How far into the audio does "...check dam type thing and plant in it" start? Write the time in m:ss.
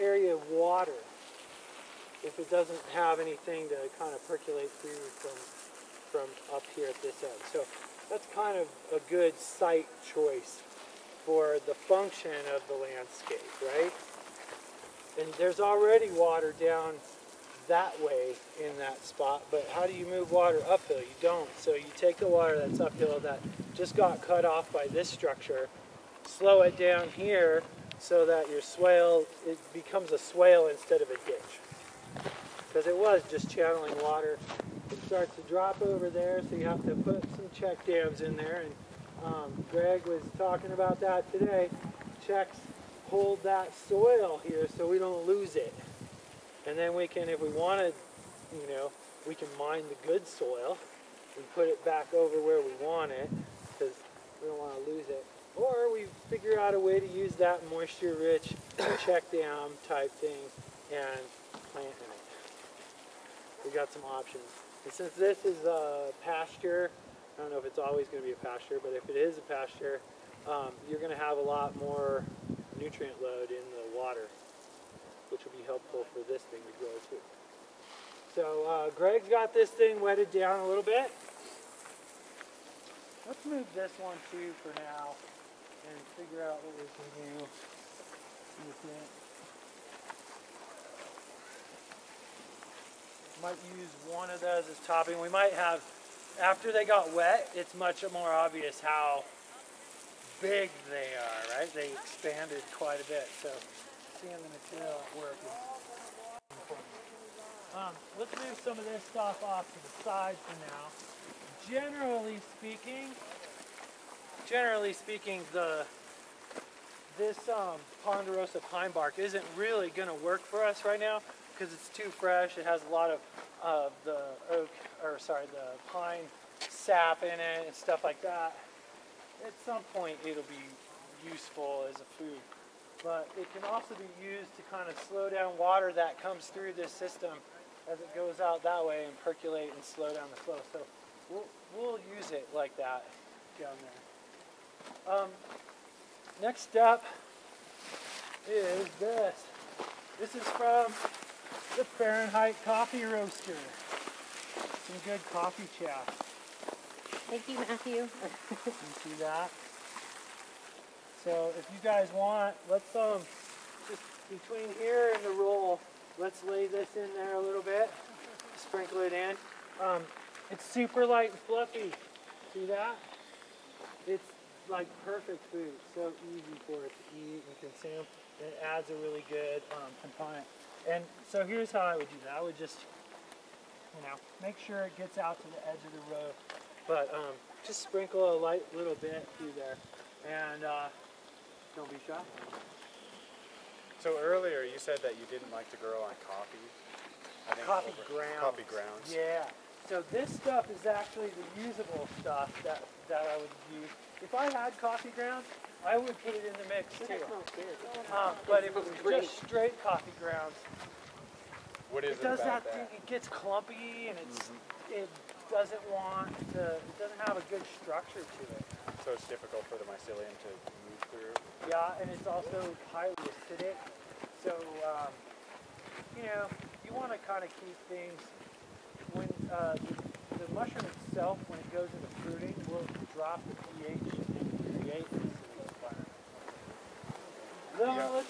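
0:59.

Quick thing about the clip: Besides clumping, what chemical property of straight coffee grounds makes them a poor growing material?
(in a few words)
highly acidic.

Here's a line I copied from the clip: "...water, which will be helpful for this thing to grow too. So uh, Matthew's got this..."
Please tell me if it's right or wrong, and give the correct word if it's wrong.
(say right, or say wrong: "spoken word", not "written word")
wrong: "Greg", not "Matthew".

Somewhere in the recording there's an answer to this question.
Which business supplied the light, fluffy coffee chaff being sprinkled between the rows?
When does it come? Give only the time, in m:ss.
2:31.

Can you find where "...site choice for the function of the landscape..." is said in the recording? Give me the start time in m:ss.
0:09.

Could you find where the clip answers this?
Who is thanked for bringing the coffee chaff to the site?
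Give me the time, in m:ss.
2:37.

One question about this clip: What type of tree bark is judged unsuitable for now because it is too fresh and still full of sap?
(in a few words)
ponderosa pine.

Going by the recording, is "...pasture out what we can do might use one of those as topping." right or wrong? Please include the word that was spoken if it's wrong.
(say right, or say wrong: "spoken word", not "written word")
wrong: "figure", not "pasture".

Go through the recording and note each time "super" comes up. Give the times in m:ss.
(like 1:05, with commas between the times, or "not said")
2:50.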